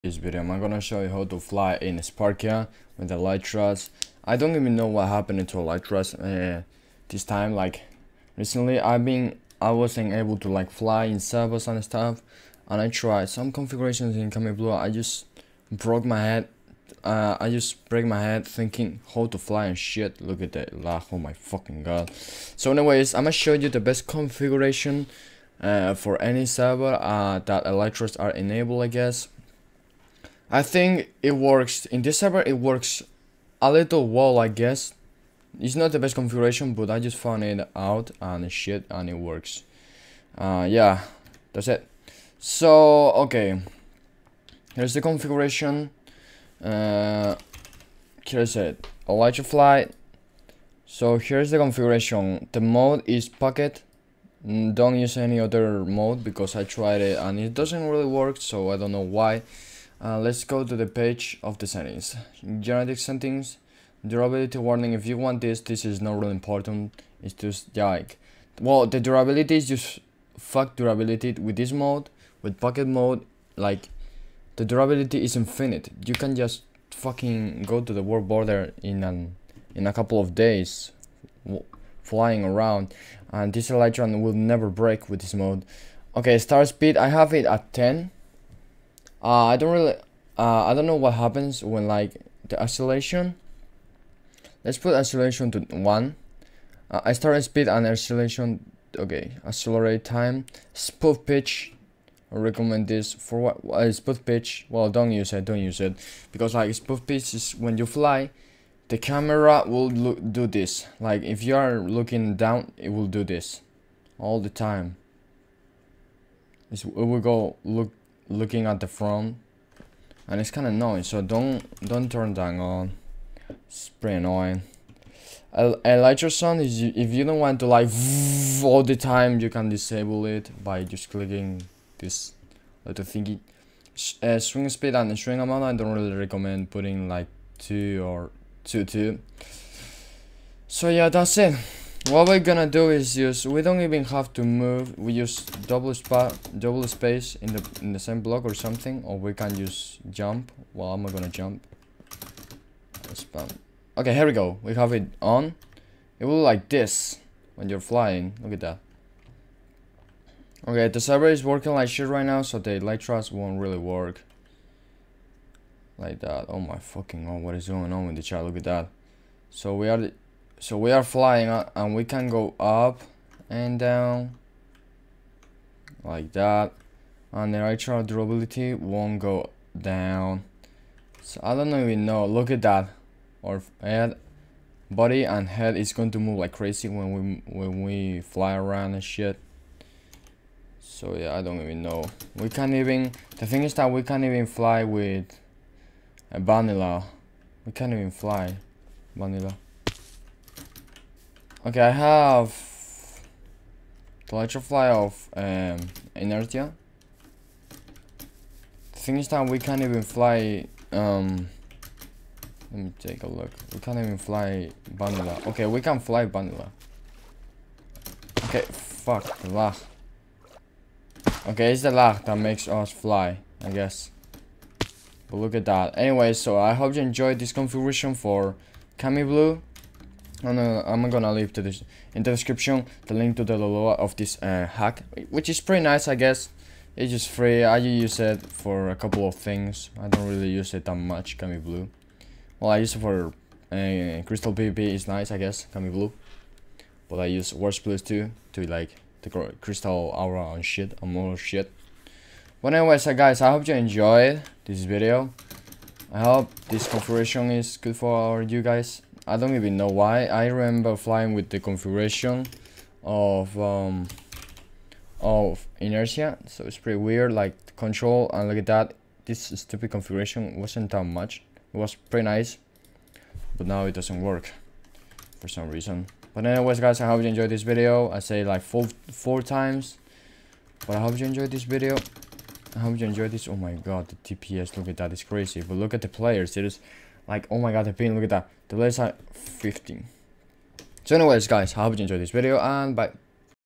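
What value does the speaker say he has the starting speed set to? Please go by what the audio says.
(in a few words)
10.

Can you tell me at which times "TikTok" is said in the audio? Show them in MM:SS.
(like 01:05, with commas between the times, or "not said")
not said.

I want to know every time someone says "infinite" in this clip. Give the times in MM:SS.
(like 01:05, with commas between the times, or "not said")
01:15.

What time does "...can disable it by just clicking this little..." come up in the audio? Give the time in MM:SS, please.
02:09.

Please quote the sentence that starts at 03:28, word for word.
Things thing is that we can't even fly, um, let me take a look.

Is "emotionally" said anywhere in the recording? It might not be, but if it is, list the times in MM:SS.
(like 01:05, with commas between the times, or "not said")
not said.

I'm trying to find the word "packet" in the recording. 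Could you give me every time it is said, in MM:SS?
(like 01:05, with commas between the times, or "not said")
00:53, 01:12.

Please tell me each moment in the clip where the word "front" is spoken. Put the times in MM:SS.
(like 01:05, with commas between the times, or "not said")
01:58.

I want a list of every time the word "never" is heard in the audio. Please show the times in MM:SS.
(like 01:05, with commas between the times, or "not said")
01:24.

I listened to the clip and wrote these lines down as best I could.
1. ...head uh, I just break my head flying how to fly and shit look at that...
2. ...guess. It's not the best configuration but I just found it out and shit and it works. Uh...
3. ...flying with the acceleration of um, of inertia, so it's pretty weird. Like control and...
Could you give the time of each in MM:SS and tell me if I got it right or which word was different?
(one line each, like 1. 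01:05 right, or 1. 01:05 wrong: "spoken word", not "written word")
1. 00:16 wrong: "thinking", not "flying"
2. 00:34 right
3. 04:20 wrong: "configuration", not "acceleration".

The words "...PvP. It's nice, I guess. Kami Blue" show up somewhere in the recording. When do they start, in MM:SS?
04:04.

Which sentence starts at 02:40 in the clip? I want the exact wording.
Okay, the server is working like shit right now, so the Elytras won't really work.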